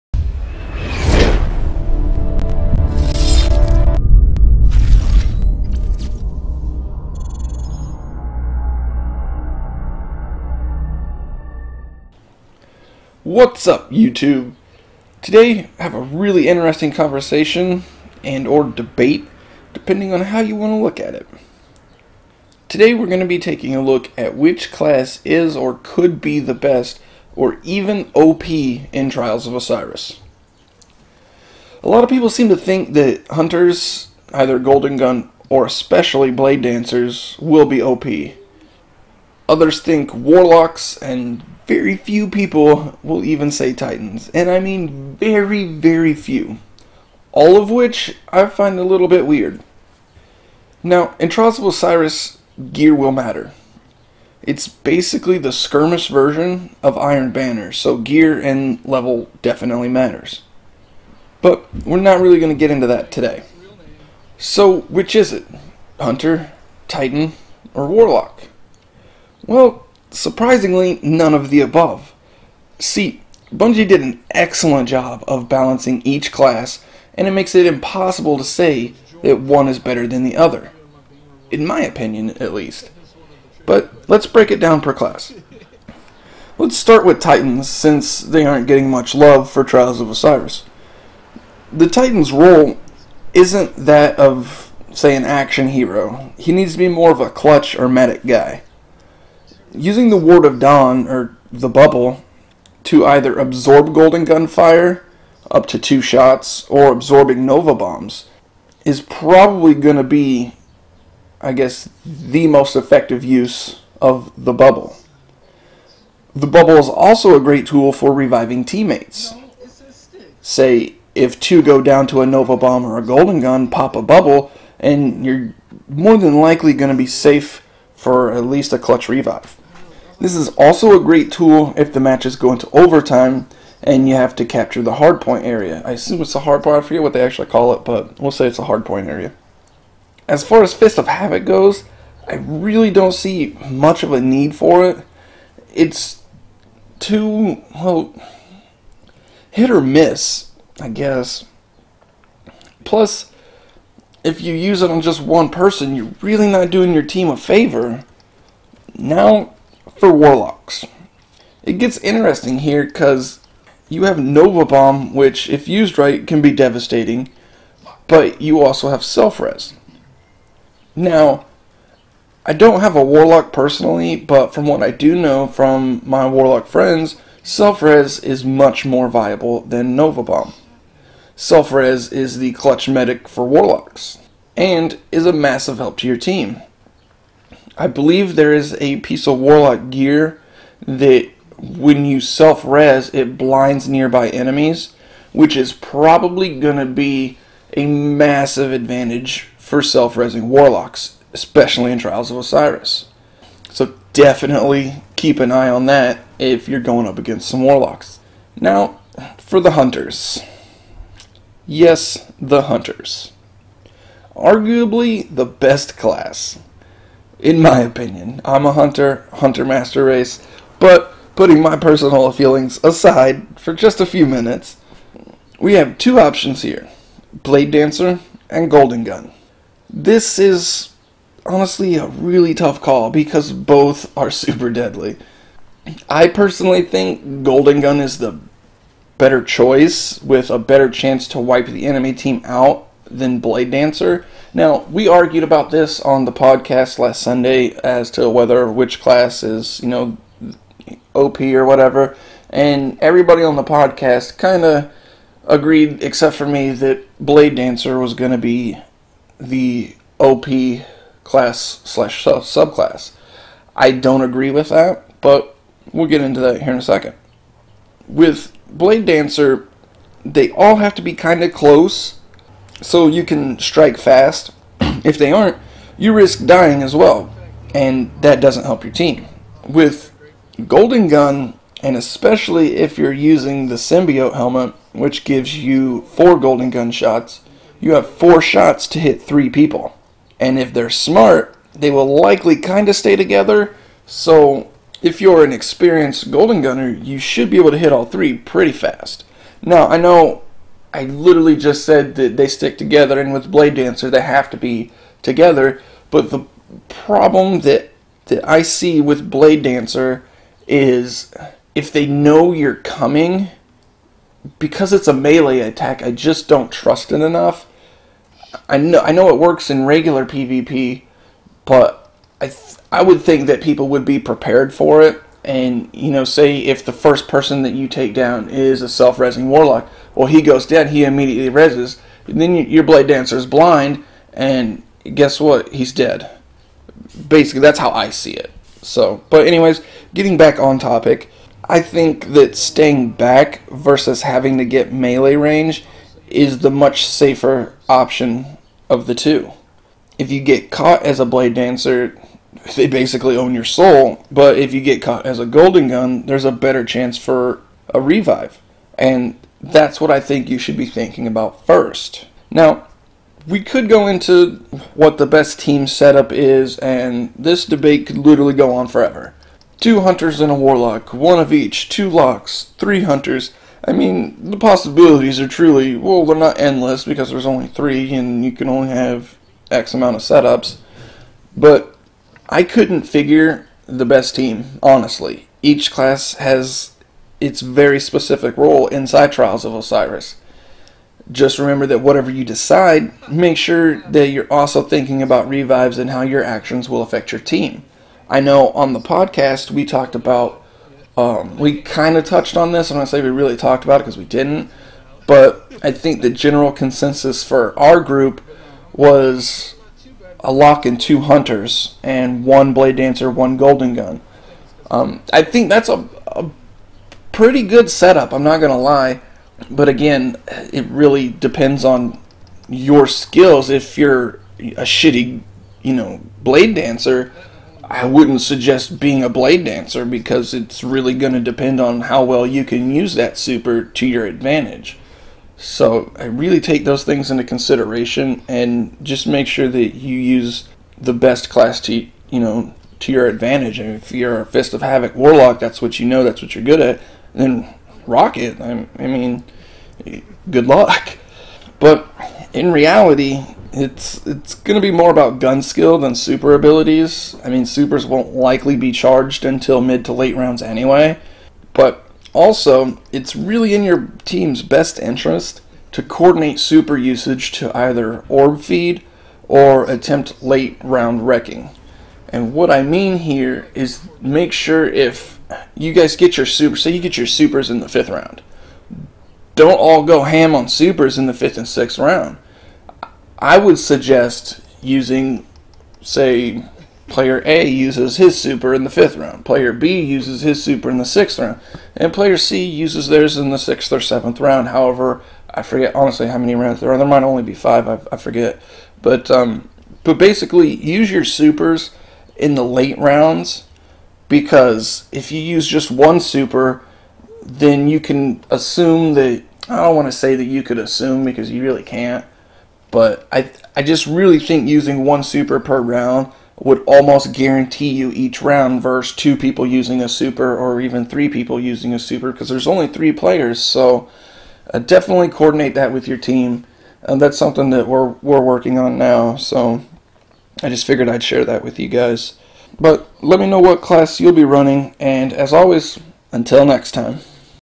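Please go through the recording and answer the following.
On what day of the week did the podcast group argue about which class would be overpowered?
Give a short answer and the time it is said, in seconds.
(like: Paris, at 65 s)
Sunday, at 247 s.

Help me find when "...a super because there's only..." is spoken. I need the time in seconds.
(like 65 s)
521 s.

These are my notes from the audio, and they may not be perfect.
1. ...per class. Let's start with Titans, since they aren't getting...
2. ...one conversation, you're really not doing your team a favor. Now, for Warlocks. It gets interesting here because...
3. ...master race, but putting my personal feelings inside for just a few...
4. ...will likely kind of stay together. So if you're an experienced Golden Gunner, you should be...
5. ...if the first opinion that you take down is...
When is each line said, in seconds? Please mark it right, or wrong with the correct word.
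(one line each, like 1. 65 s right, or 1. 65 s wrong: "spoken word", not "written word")
1. 84 s right
2. 155 s wrong: "person", not "conversation"
3. 219 s wrong: "aside", not "inside"
4. 291 s right
5. 326 s wrong: "person", not "opinion".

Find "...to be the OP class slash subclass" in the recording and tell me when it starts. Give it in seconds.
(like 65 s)
258 s.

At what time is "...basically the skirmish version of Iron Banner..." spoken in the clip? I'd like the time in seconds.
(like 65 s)
54 s.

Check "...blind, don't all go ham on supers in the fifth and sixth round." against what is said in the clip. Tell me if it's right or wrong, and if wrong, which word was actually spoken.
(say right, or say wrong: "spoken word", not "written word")
wrong: "round", not "blind".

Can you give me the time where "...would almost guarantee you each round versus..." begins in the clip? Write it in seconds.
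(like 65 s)
516 s.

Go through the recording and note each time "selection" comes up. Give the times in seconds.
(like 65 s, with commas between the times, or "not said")
not said.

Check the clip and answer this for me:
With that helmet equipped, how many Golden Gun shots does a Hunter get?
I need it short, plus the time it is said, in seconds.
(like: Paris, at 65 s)
4, at 286 s.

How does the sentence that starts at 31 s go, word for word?
A lot of people seem to think that hunters, either Golden Gun or especially Blade Dancers, will be OP.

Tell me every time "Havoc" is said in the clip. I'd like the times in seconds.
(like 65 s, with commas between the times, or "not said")
141 s, 444 s.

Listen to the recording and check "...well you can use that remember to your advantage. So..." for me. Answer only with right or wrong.
wrong.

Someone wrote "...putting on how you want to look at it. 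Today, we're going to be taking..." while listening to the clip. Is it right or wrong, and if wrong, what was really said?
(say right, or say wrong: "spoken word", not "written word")
wrong: "depending", not "putting".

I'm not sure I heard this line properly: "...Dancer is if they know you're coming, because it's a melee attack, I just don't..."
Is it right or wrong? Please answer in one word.
right.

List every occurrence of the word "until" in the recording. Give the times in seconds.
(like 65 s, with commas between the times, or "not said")
459 s, 536 s.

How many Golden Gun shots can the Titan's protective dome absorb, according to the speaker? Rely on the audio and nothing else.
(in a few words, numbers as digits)
2.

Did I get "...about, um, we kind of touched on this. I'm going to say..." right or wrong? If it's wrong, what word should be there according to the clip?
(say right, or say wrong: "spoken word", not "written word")
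right.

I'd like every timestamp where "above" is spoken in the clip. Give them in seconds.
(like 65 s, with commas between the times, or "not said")
71 s.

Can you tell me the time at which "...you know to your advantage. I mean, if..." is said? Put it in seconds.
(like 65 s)
442 s.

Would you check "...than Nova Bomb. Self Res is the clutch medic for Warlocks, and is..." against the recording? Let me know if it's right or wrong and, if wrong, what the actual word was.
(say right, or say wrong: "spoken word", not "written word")
right.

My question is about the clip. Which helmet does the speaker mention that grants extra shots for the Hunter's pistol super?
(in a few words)
Symbiote.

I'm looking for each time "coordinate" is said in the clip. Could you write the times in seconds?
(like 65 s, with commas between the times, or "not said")
466 s, 525 s.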